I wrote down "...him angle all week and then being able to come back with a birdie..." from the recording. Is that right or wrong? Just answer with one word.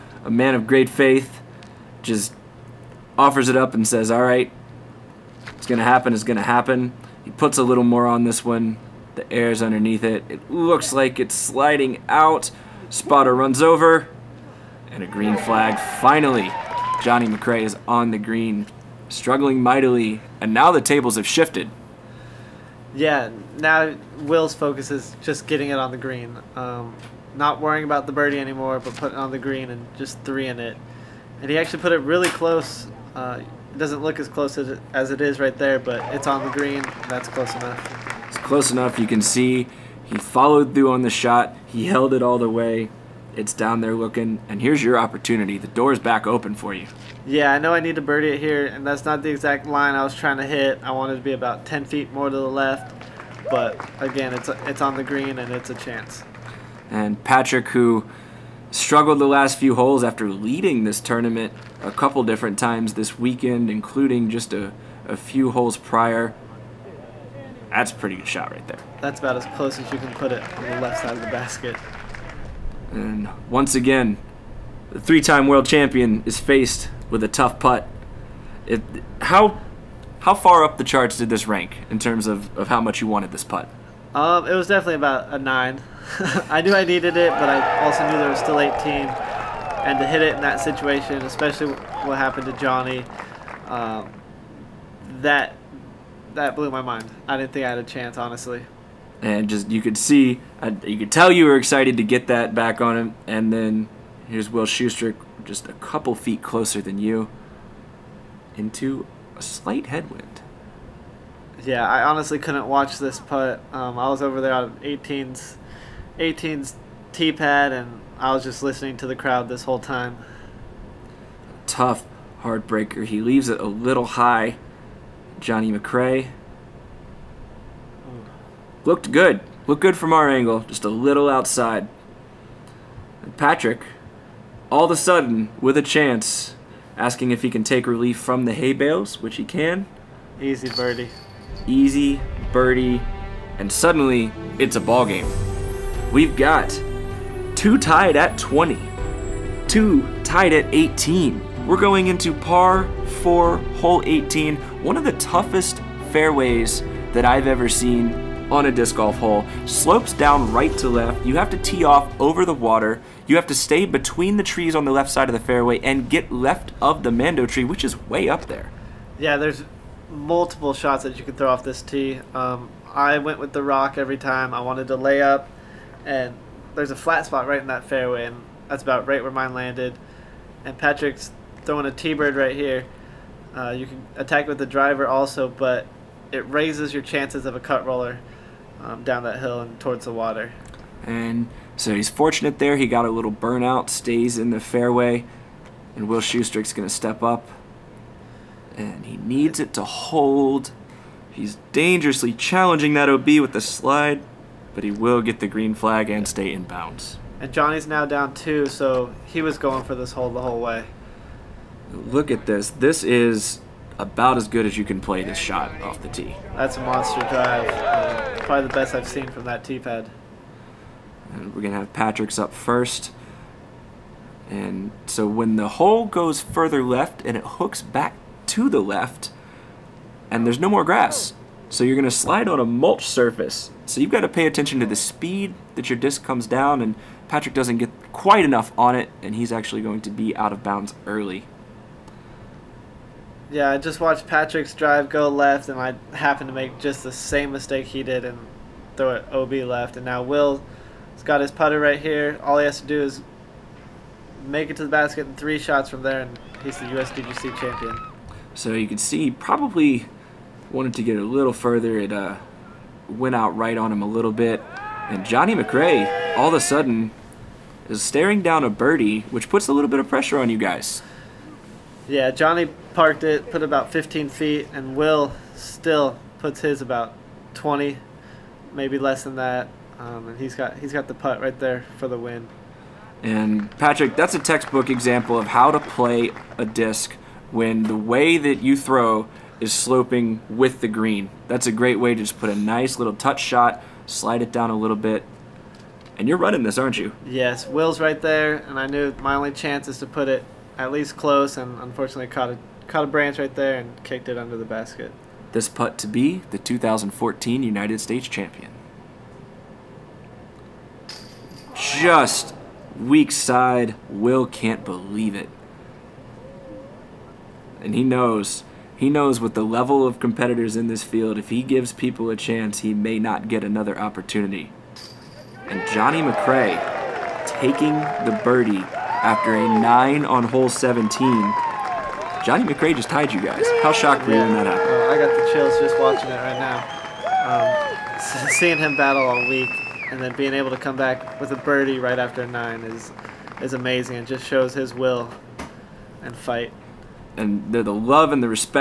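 wrong.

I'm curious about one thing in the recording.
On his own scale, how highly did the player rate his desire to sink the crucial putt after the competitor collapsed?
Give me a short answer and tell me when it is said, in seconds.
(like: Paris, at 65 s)
9, at 84 s.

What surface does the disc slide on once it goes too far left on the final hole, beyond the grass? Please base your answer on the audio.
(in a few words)
mulch.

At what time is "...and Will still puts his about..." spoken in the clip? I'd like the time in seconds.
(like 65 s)
274 s.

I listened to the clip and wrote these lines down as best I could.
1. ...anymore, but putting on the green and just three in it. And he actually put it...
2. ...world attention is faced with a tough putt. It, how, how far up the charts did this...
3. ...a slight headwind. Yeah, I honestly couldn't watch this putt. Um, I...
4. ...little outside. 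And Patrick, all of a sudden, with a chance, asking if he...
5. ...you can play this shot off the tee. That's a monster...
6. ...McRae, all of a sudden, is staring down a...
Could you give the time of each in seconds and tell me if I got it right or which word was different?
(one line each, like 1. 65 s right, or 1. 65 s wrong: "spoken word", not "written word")
1. 28 s right
2. 75 s wrong: "champion", not "attention"
3. 109 s right
4. 130 s right
5. 214 s right
6. 265 s right.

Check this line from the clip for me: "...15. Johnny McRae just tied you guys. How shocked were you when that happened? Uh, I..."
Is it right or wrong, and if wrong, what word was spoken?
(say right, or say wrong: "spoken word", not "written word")
wrong: "17", not "15".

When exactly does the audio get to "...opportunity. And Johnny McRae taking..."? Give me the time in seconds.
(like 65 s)
323 s.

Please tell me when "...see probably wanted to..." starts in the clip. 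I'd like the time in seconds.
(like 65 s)
258 s.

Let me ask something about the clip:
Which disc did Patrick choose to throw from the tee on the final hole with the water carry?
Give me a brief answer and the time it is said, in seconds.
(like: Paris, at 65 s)
Teebird, at 181 s.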